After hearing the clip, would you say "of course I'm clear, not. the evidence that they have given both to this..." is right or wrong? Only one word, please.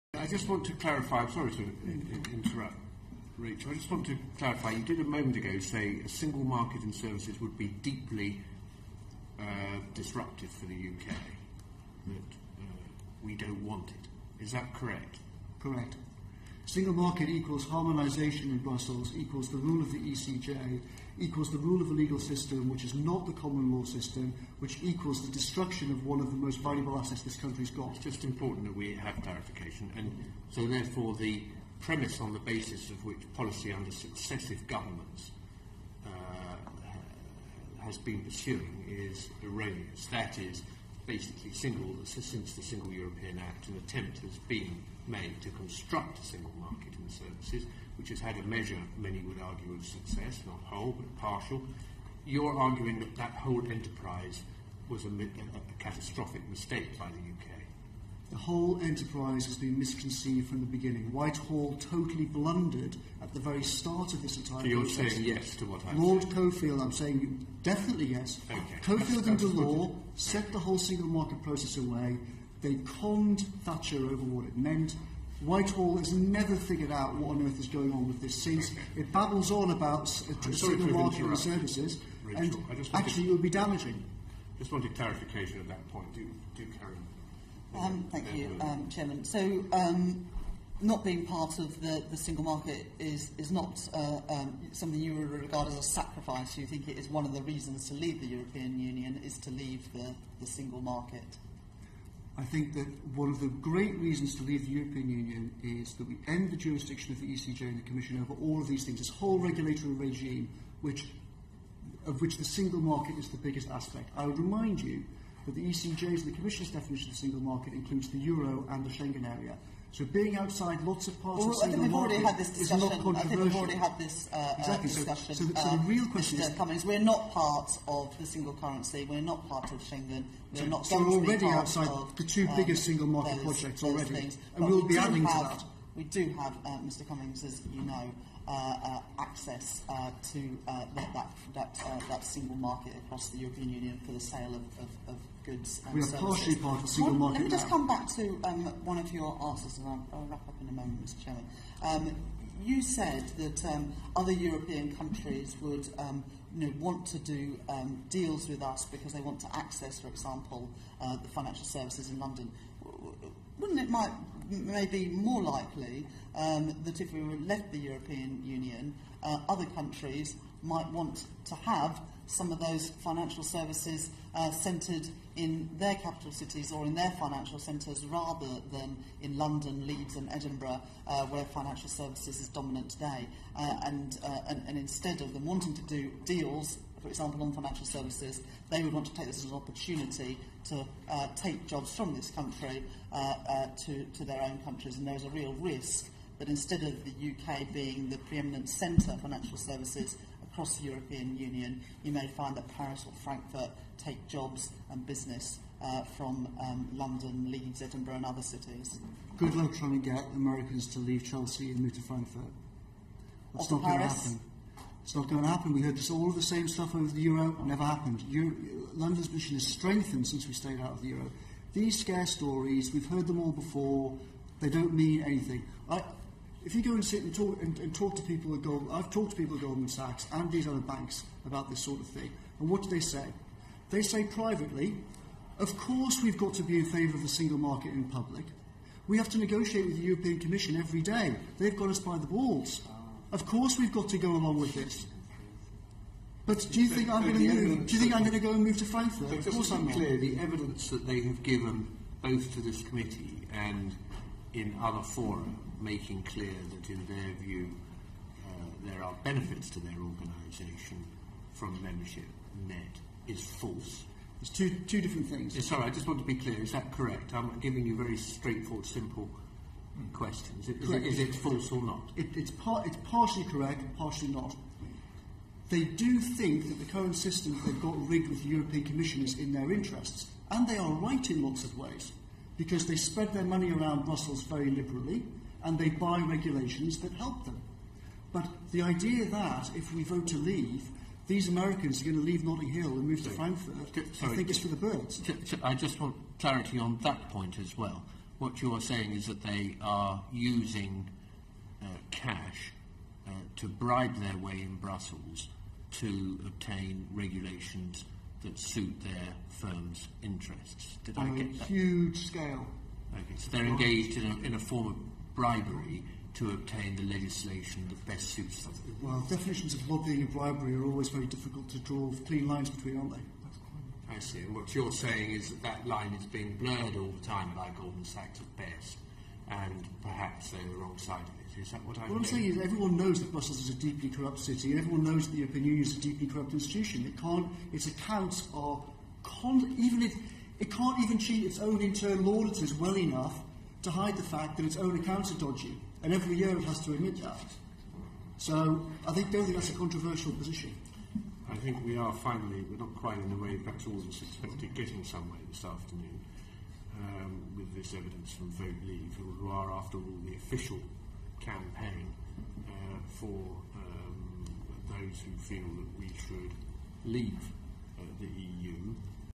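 right.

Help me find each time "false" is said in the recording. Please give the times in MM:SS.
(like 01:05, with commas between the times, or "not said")
04:23, 04:31.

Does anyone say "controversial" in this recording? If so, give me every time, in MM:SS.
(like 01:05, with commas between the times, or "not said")
02:03, 05:49.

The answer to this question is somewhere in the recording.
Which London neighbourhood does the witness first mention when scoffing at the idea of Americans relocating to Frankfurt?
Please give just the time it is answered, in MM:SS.
03:31.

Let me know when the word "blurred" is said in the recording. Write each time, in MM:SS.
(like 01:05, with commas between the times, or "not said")
05:26.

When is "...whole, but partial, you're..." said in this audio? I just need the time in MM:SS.
00:50.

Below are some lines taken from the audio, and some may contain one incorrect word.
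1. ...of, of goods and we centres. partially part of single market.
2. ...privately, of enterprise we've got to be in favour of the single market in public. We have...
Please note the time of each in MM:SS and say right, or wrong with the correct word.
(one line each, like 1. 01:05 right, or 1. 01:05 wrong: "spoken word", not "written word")
1. 02:24 wrong: "services", not "centres"
2. 03:54 wrong: "course", not "enterprise".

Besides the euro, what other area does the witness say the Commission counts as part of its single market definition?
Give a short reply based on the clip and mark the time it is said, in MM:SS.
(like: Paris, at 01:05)
Schengen area, at 01:58.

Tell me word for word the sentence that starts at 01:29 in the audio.
So, um, not being part of the, the single market is, is not uh, um, something you would regard as a sacrifice.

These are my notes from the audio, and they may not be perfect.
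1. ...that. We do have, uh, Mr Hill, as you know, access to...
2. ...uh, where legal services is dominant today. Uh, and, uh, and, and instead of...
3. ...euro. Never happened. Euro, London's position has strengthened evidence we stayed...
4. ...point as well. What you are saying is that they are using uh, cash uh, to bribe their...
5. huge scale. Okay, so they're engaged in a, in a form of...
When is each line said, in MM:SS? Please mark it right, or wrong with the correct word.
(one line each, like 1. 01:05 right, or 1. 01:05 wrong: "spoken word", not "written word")
1. 02:15 wrong: "Cummings", not "Hill"
2. 03:01 wrong: "financial", not "legal"
3. 03:37 wrong: "since", not "evidence"
4. 04:57 right
5. 05:11 right.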